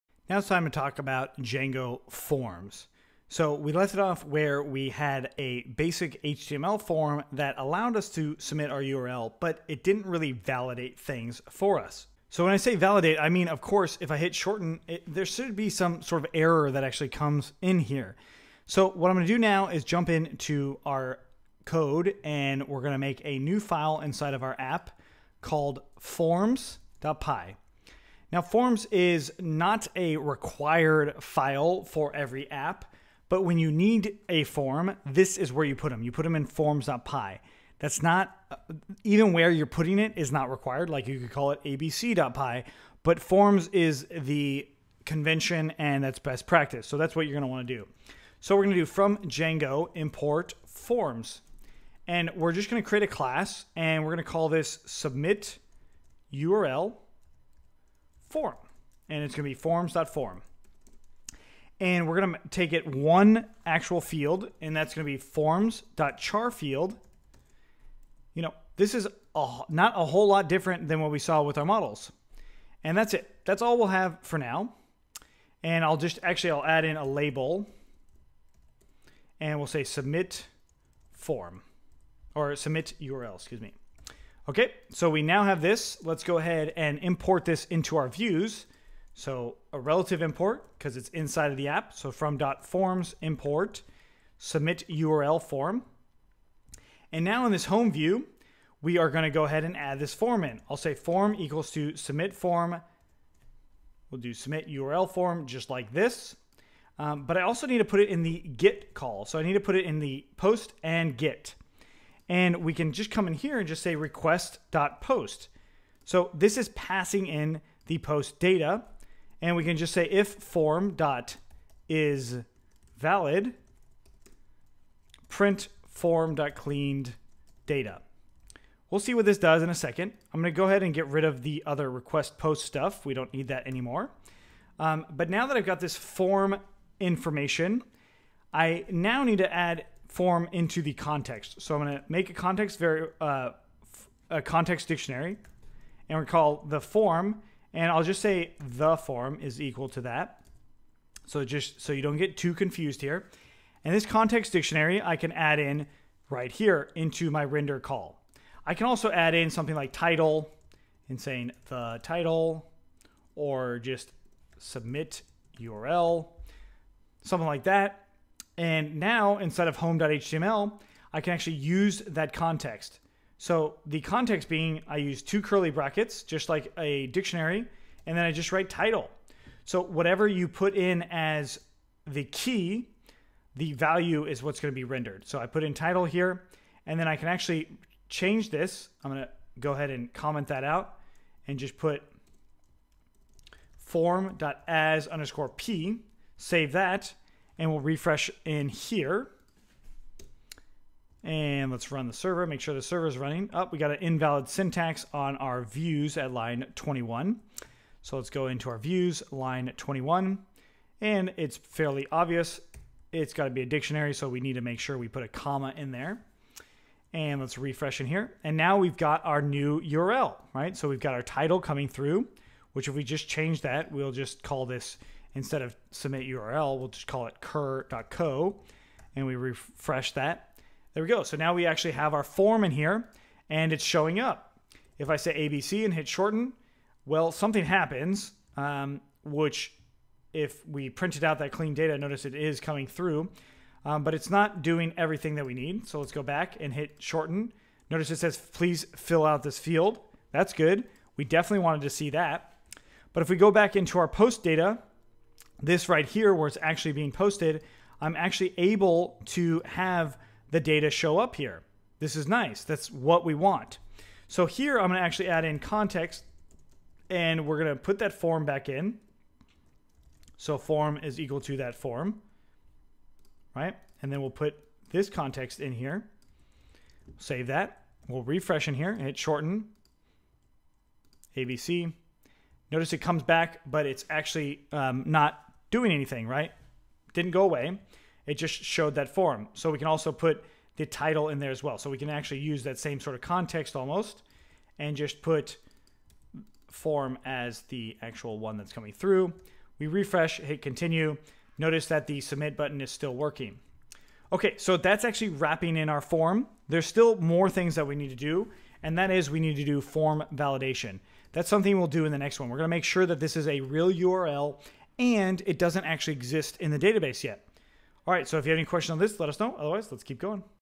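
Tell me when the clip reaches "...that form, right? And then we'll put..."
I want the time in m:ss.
4:31.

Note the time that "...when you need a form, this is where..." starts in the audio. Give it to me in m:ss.
0:33.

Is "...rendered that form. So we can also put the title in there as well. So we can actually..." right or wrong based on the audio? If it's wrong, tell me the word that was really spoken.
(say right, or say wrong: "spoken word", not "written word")
wrong: "showed", not "rendered".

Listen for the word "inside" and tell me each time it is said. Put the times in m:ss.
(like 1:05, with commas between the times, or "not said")
0:23, 1:31.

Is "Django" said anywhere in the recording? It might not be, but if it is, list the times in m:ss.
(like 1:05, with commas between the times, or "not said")
0:01, 0:49.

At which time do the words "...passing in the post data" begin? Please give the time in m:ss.
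1:56.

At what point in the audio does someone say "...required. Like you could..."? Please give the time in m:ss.
0:40.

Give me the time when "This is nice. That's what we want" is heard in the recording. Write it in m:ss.
4:21.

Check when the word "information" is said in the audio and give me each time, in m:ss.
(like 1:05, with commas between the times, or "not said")
2:16.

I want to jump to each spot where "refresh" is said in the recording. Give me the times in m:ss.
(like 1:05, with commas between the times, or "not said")
3:17, 3:37, 3:49, 4:38, 4:59.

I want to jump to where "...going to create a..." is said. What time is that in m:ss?
0:52.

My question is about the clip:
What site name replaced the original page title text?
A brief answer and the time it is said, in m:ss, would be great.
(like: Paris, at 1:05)
kirr.co, at 3:47.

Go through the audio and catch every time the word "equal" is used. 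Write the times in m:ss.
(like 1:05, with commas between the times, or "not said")
1:41, 2:29, 4:31.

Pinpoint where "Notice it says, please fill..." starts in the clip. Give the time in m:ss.
4:07.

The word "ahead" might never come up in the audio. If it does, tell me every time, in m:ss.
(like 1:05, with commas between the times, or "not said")
1:26, 1:39, 2:10, 3:09.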